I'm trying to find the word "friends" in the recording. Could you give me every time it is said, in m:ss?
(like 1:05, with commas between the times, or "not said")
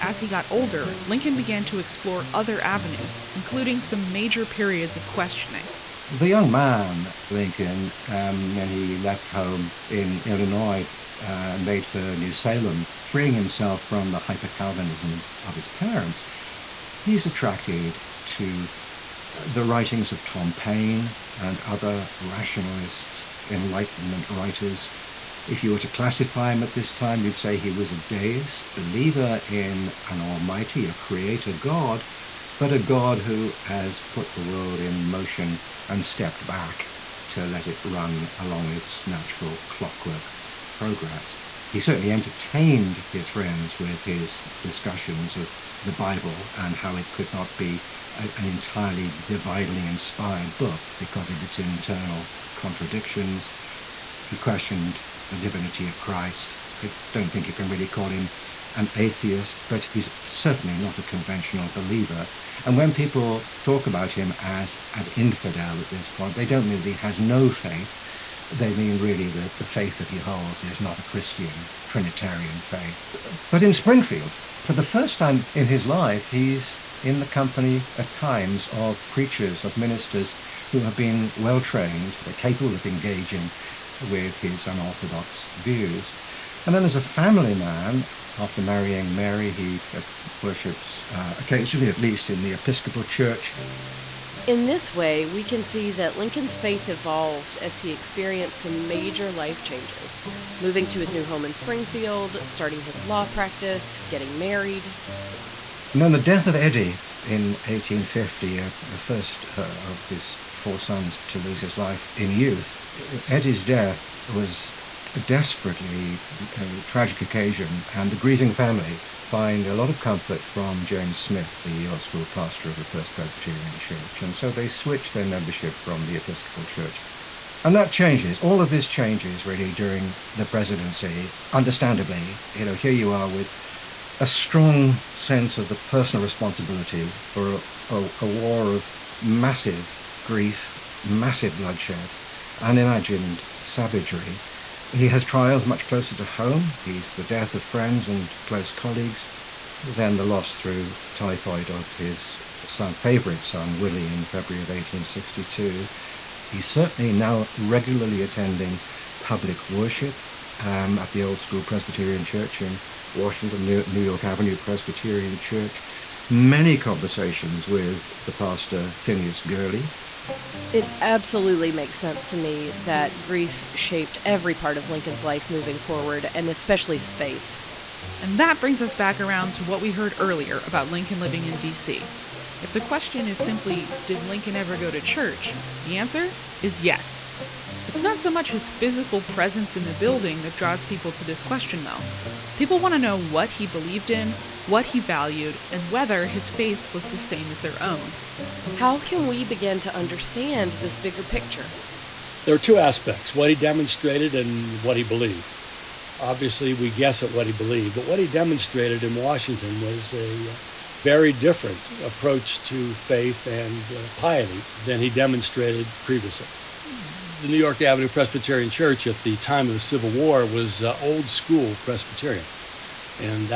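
0:43, 2:27.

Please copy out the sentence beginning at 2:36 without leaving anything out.
He's certainly now regularly attending public worship um, at the old school Presbyterian Church in Washington, New, New York Avenue Presbyterian Church.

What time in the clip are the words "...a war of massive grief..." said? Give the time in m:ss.
2:18.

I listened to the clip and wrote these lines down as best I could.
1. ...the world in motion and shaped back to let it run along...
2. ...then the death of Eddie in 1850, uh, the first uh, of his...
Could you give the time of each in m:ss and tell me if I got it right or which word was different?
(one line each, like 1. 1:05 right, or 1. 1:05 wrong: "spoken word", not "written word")
1. 0:34 wrong: "stepped", not "shaped"
2. 1:46 right.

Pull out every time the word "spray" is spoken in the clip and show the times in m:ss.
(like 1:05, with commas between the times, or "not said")
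not said.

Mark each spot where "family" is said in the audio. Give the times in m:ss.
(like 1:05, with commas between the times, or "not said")
1:27, 1:58.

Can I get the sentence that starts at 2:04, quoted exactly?
And so they switch their membership from the Episcopal Church.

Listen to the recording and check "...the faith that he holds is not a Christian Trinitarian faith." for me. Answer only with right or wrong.
right.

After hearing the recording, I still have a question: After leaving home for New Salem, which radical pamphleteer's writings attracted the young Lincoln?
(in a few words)
Tom Paine.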